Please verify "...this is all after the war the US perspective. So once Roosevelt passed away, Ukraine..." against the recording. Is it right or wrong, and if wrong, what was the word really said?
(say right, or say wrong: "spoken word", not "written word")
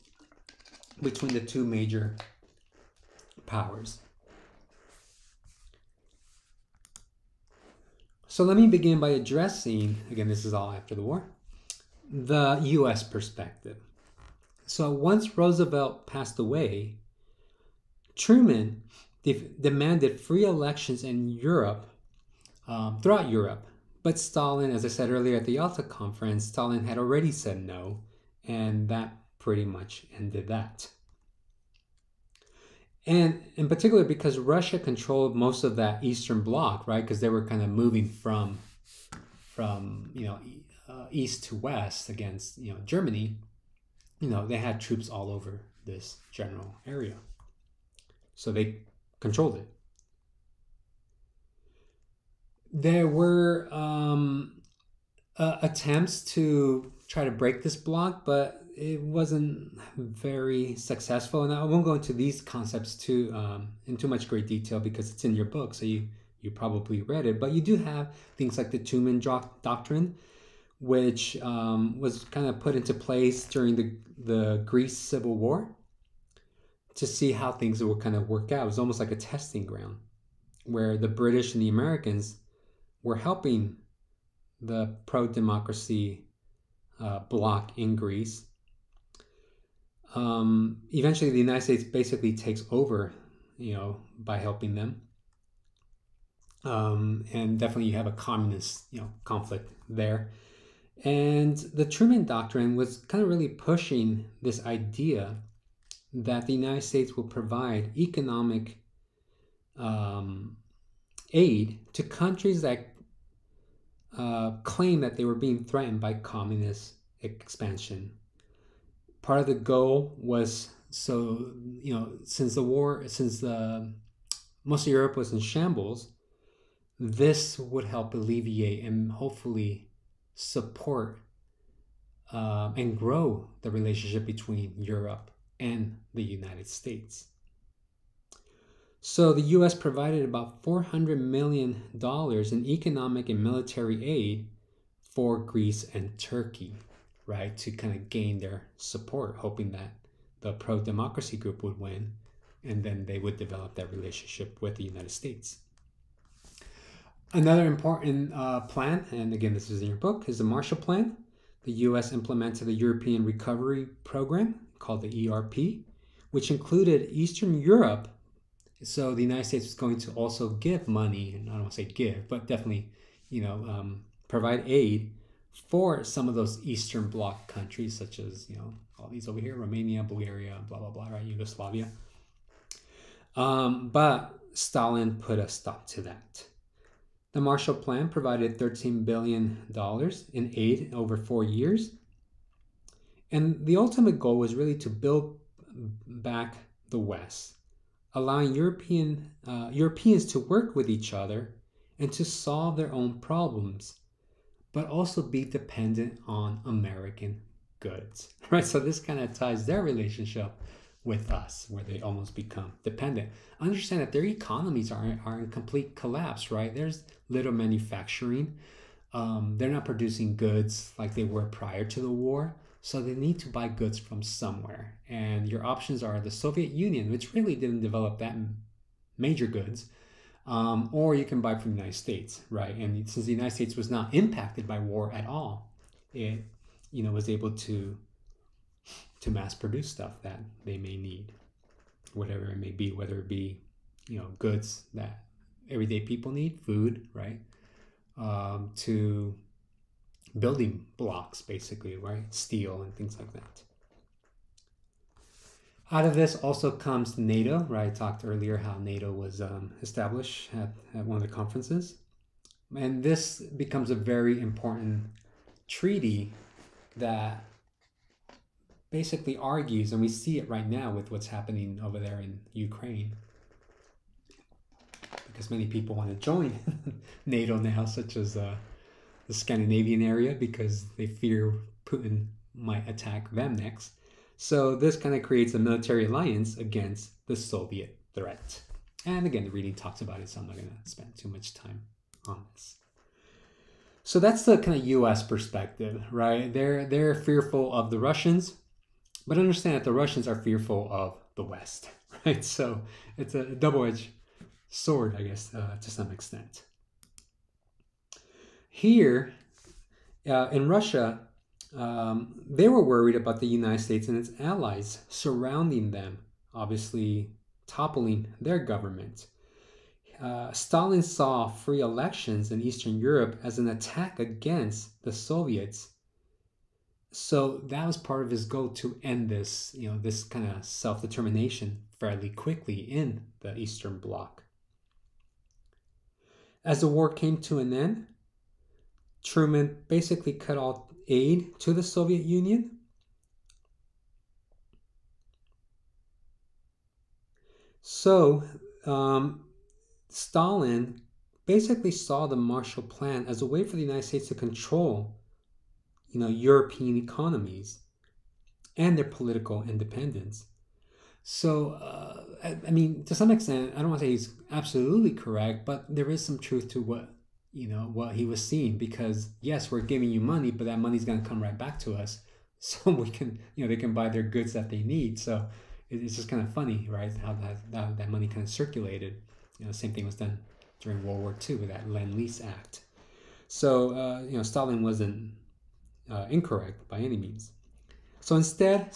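wrong: "Truman", not "Ukraine".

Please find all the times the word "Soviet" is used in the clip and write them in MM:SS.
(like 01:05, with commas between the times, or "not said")
03:46, 04:47, 05:25, 05:41.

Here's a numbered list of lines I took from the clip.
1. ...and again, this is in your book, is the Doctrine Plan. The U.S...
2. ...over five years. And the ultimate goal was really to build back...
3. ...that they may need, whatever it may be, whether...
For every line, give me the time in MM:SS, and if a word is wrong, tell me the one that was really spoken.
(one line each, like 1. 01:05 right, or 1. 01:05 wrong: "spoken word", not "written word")
1. 02:39 wrong: "Marshall", not "Doctrine"
2. 03:10 wrong: "four", not "five"
3. 04:00 right.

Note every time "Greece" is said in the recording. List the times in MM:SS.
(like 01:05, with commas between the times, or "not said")
01:14, 01:27, 02:25.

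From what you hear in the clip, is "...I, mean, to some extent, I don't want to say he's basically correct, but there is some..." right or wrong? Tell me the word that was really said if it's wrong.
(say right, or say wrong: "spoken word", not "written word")
wrong: "absolutely", not "basically".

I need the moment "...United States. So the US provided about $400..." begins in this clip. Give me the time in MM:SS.
02:16.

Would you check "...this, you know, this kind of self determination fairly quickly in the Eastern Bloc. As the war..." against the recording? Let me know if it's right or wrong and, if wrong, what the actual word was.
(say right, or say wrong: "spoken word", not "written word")
right.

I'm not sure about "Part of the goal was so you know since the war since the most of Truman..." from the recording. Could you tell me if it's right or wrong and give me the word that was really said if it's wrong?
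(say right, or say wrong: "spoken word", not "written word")
wrong: "Europe", not "Truman".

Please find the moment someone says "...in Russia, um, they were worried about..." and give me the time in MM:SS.
05:10.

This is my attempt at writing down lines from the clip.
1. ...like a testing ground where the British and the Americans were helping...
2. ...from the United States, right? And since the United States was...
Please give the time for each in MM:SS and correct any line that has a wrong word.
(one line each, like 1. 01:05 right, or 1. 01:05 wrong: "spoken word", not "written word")
1. 01:18 right
2. 03:51 right.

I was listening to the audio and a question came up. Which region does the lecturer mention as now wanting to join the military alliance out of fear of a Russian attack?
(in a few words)
Scandinavian area.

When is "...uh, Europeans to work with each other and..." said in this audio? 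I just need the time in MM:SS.
03:19.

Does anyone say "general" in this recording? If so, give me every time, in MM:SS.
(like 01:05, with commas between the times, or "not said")
00:46.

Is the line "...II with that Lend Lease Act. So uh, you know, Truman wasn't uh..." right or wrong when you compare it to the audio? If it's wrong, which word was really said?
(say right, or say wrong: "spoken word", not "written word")
wrong: "Stalin", not "Truman".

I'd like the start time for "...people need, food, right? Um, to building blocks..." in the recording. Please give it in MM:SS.
04:05.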